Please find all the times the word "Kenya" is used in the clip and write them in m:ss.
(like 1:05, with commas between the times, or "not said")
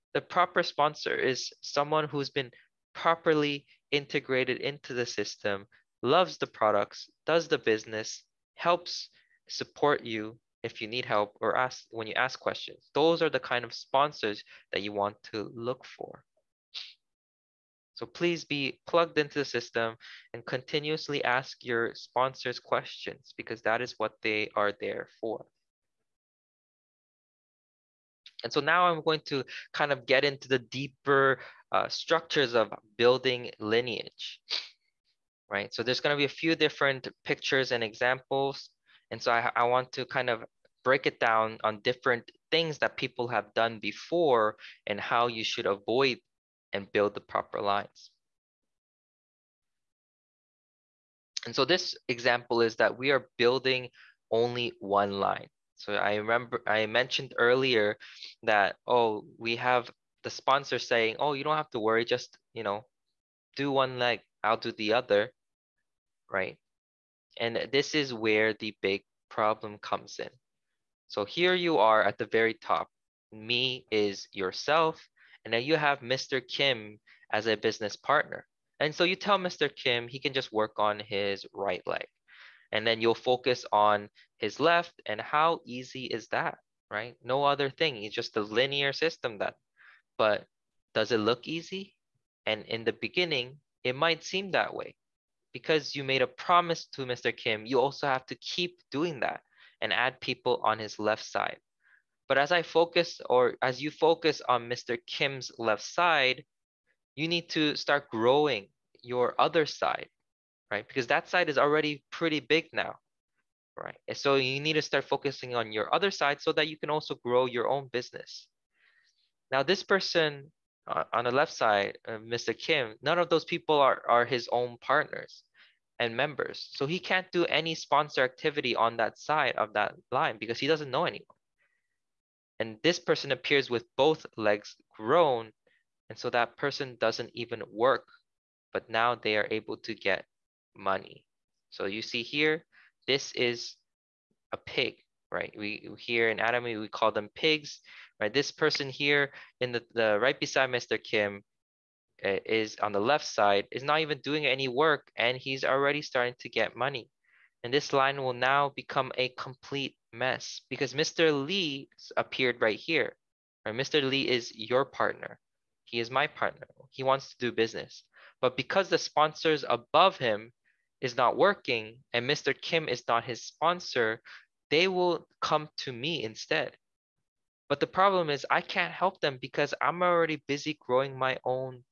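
not said.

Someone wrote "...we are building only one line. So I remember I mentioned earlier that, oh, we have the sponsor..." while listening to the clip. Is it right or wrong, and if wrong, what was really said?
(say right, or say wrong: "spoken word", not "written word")
right.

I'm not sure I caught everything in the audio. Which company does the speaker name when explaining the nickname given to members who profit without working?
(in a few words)
Atomy.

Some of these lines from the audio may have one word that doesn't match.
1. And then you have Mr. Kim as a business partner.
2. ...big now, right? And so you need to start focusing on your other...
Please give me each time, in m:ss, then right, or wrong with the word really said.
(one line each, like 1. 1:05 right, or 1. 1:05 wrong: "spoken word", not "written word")
1. 1:15 right
2. 1:52 right.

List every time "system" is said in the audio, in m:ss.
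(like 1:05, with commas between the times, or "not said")
0:05, 0:19, 1:28.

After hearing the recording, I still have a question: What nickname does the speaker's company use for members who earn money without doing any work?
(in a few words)
pigs.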